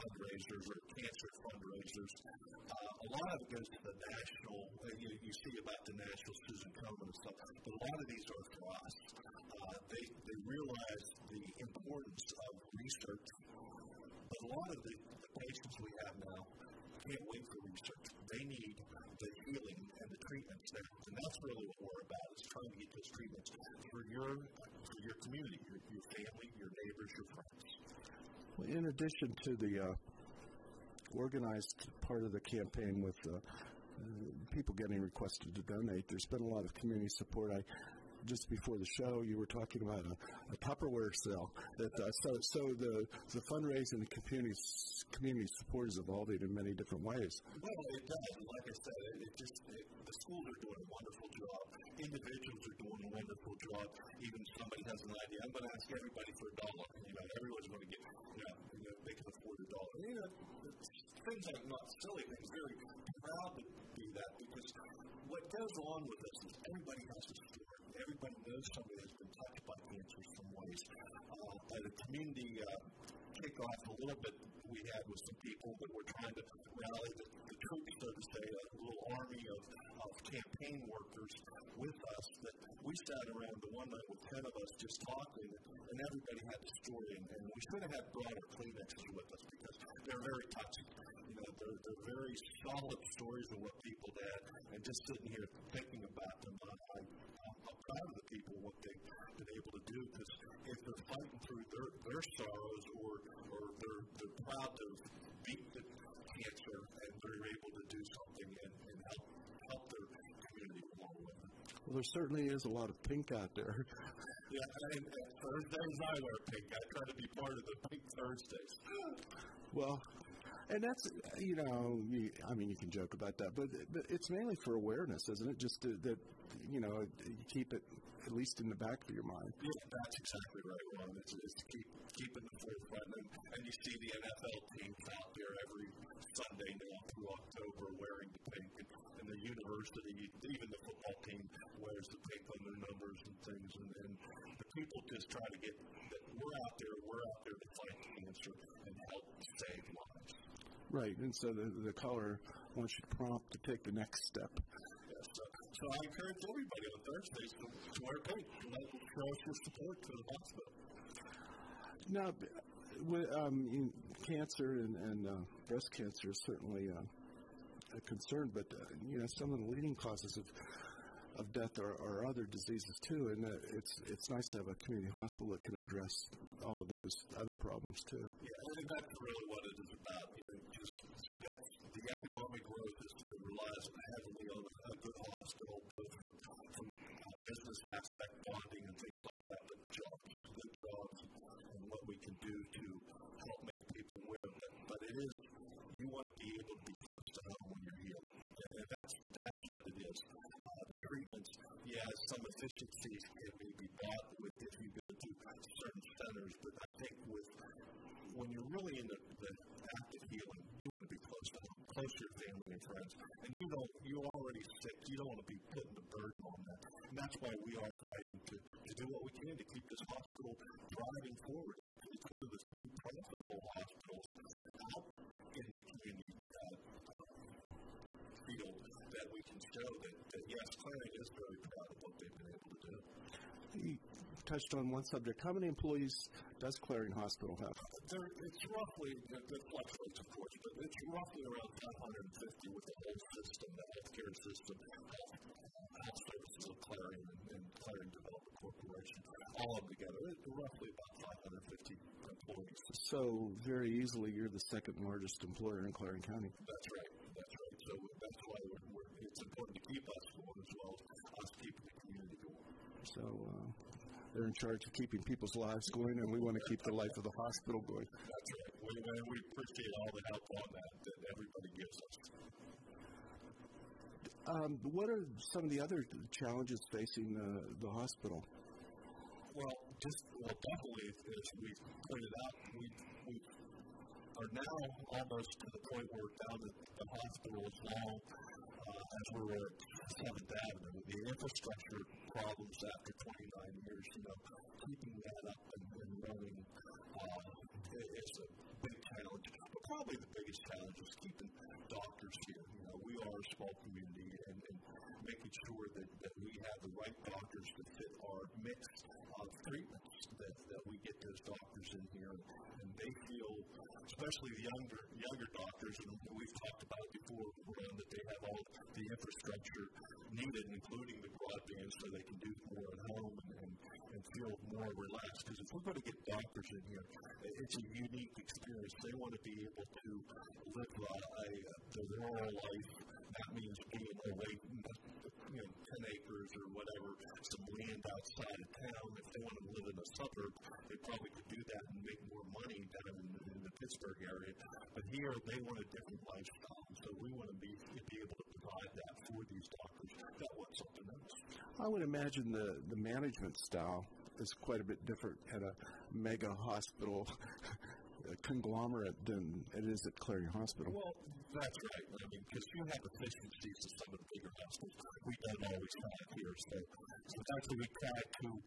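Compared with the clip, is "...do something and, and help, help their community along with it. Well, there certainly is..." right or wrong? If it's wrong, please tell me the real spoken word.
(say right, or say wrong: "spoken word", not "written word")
right.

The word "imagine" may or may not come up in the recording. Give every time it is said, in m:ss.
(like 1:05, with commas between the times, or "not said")
5:52.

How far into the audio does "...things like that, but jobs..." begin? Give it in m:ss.
3:09.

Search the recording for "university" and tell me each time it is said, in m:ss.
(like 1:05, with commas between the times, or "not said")
2:19.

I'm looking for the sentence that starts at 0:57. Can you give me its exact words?
You know, everyone's going to get.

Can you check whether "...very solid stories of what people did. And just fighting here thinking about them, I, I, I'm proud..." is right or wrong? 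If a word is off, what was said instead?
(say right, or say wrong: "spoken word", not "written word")
wrong: "sitting", not "fighting".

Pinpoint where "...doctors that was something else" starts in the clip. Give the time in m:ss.
5:49.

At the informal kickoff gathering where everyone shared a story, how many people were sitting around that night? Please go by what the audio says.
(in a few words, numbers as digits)
10.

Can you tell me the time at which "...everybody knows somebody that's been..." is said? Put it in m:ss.
1:07.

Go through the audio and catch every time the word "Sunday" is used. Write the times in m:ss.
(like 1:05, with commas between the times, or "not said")
2:16.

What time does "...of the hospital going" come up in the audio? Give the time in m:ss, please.
4:27.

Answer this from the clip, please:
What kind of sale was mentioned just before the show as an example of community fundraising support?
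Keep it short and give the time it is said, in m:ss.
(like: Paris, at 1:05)
Tupperware sale, at 0:40.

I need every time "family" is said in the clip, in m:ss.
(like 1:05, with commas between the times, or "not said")
0:26, 3:32.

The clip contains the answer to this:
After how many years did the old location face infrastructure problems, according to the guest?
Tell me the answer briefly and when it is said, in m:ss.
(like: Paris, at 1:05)
29, at 4:53.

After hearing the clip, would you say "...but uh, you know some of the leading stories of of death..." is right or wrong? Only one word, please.
wrong.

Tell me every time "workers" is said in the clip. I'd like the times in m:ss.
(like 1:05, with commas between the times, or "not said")
1:20.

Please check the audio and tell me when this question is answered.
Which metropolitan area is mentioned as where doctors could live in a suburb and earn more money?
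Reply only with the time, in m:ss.
5:43.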